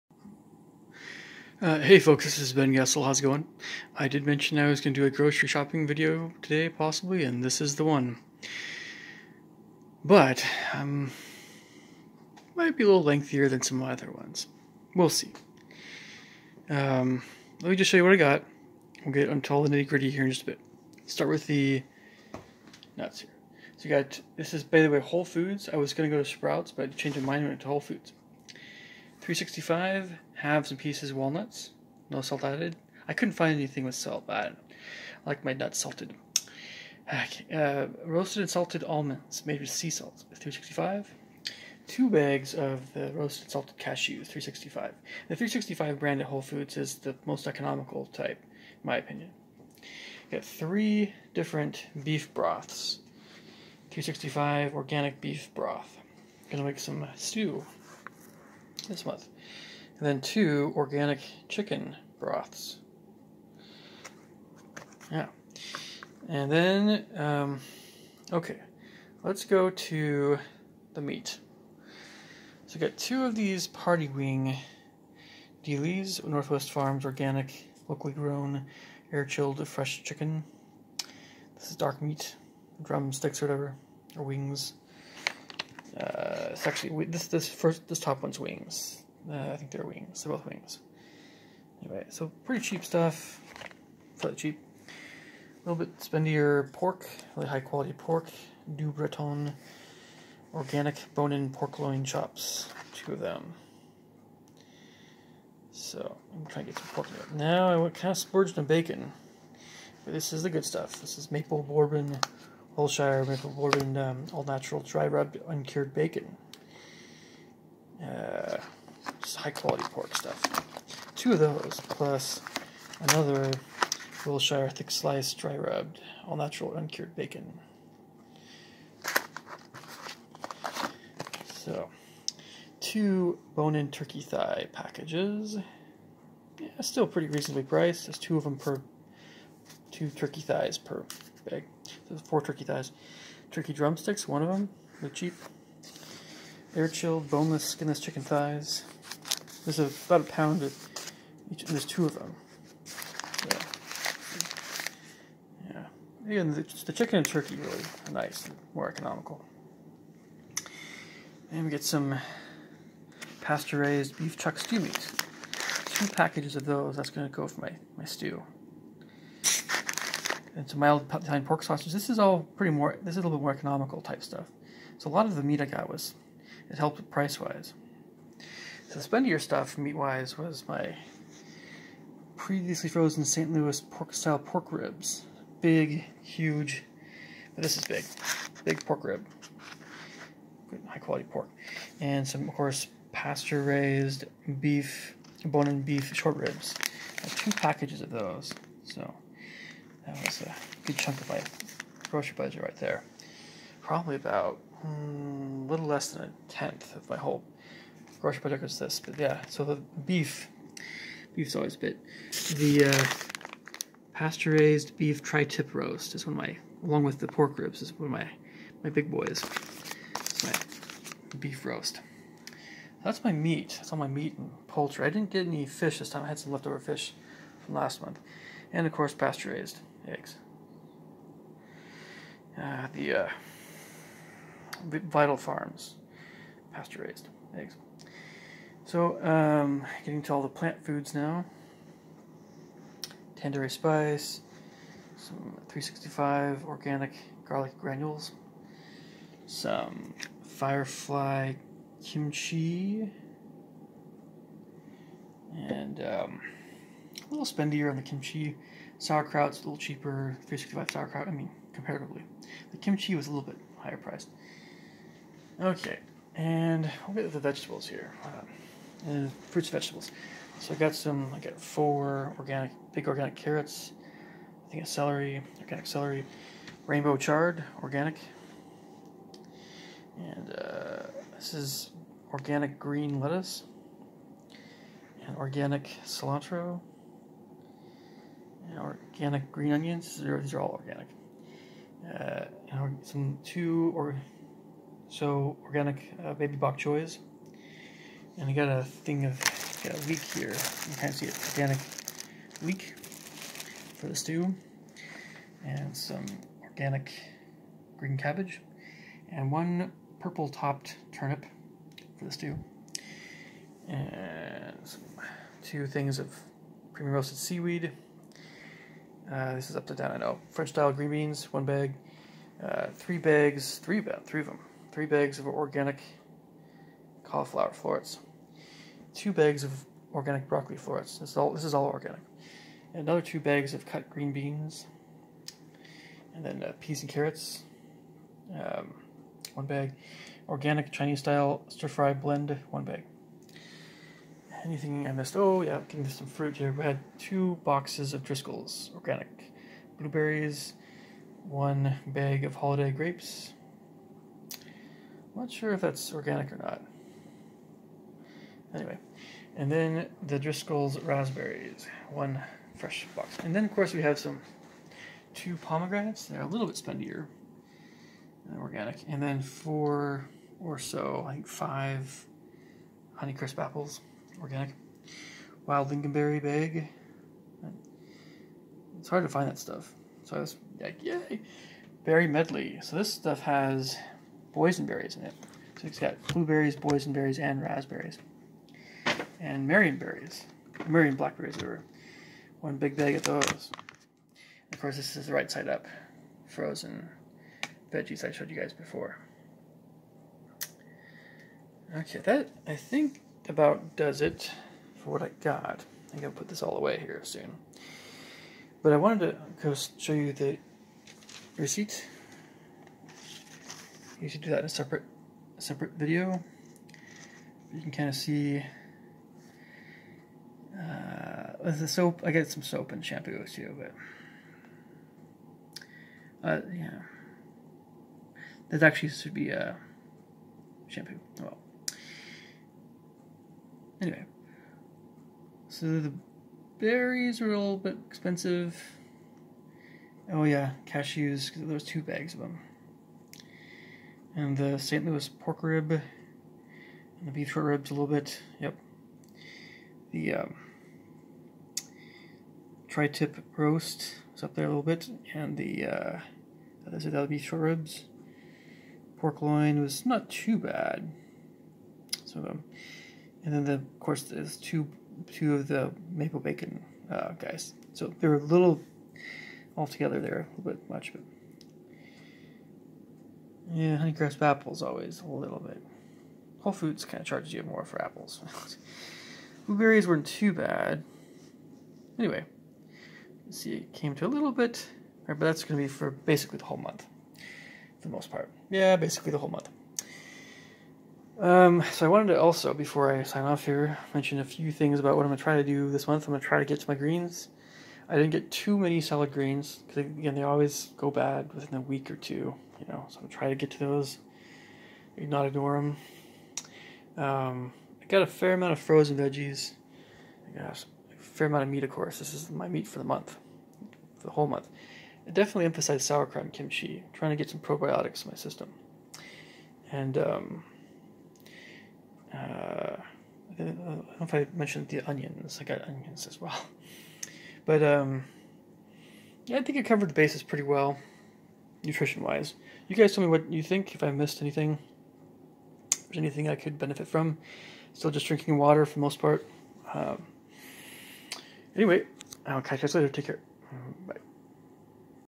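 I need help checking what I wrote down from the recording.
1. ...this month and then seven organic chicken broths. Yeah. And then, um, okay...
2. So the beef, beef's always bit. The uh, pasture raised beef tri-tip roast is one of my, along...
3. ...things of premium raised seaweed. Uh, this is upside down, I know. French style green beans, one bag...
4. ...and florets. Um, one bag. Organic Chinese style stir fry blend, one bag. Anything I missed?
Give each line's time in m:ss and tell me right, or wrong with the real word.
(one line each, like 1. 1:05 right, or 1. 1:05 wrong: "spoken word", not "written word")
1. 0:58 wrong: "two", not "seven"
2. 3:29 right
3. 5:15 wrong: "roasted", not "raised"
4. 5:37 wrong: "carrots", not "florets".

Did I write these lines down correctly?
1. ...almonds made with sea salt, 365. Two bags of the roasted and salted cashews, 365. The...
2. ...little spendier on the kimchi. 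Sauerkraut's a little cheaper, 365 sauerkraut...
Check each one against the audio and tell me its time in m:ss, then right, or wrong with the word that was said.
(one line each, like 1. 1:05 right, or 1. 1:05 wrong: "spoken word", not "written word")
1. 0:38 right
2. 4:17 right.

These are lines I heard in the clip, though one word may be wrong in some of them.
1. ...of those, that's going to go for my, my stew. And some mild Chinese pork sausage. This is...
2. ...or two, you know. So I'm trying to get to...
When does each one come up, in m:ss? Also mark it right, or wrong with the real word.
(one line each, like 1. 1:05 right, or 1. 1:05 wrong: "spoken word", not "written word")
1. 2:46 wrong: "Italian", not "Chinese"
2. 8:22 right.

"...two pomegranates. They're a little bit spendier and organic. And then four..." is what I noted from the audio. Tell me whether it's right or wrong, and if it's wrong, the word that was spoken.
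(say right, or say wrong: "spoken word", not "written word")
right.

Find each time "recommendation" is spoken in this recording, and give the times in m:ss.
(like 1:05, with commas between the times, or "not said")
not said.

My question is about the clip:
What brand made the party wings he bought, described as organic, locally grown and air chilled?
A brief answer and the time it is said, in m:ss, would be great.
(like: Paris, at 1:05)
Northwest Farms, at 1:16.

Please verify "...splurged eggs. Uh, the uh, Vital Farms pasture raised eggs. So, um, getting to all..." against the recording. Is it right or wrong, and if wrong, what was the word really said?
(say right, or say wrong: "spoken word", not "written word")
wrong: "raised", not "splurged".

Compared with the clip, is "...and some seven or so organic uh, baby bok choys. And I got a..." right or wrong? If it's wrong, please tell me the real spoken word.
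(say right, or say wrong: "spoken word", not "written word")
wrong: "two", not "seven".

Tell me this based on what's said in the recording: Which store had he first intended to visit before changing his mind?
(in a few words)
Sprouts.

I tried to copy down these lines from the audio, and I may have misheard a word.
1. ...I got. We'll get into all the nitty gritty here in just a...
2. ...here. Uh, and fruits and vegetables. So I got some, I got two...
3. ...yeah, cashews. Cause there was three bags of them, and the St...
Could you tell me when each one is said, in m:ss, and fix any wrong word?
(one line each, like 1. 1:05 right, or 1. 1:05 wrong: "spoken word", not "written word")
1. 0:18 right
2. 4:27 wrong: "four", not "two"
3. 7:20 wrong: "two", not "three".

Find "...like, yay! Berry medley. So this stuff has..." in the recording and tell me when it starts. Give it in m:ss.
6:20.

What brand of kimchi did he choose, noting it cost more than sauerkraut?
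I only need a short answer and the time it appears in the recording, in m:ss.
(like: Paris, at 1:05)
Firefly, at 4:10.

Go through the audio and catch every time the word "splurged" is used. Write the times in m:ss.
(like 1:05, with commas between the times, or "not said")
1:48.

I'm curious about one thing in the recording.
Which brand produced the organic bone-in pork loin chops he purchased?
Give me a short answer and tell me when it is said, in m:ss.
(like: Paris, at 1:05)
Du Breton, at 1:38.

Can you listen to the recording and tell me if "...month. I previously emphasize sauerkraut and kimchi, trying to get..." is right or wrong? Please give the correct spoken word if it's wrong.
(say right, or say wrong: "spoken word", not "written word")
wrong: "definitely", not "previously".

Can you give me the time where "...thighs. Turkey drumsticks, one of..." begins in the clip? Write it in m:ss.
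2:22.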